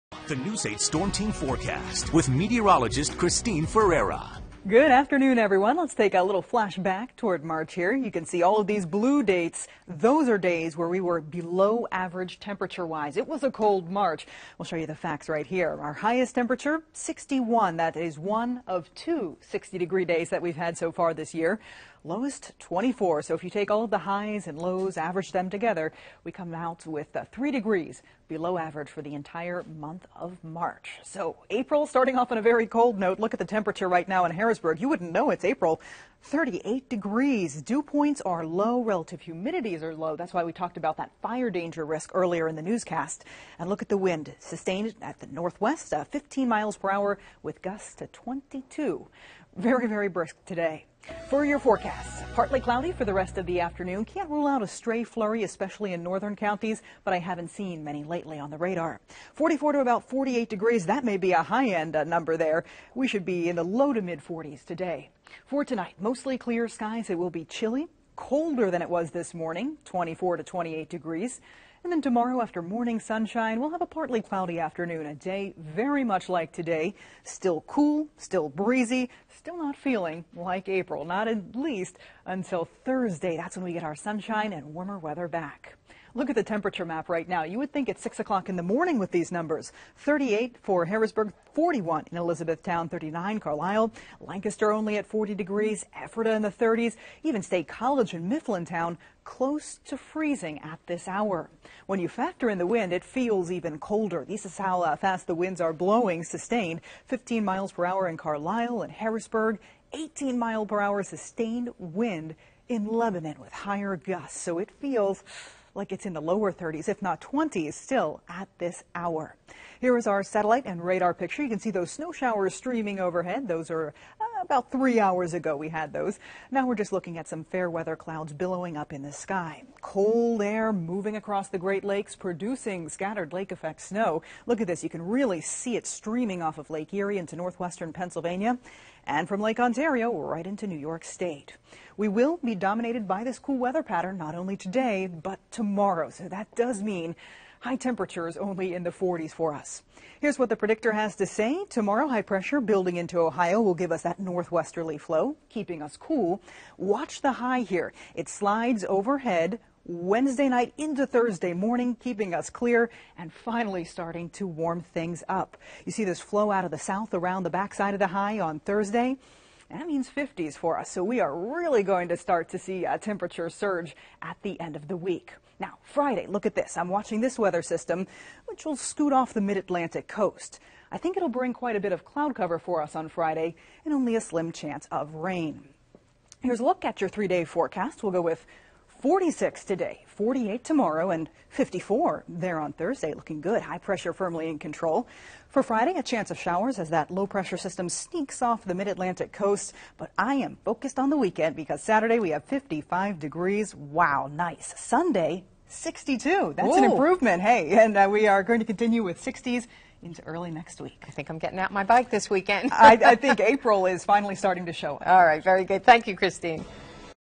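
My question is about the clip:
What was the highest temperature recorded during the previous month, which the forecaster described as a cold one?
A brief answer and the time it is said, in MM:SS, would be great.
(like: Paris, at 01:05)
61, at 00:16.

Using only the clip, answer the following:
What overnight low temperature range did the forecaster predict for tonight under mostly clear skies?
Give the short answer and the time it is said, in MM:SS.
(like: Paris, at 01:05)
24 to 28 degrees, at 01:09.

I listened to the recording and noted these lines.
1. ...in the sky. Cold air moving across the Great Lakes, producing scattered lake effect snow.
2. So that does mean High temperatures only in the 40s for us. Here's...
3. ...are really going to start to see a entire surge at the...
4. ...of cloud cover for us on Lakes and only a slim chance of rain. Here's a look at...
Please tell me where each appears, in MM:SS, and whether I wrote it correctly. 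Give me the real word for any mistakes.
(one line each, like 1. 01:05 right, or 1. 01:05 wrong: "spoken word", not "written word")
1. 02:08 right
2. 02:26 right
3. 02:51 wrong: "temperature", not "entire"
4. 03:01 wrong: "Friday", not "Lakes".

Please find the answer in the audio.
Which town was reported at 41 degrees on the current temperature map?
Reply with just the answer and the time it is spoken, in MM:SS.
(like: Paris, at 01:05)
Elizabethtown, at 01:32.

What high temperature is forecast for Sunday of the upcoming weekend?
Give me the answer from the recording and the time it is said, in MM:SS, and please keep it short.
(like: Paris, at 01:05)
62, at 03:25.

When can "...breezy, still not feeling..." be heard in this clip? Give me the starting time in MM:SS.
01:18.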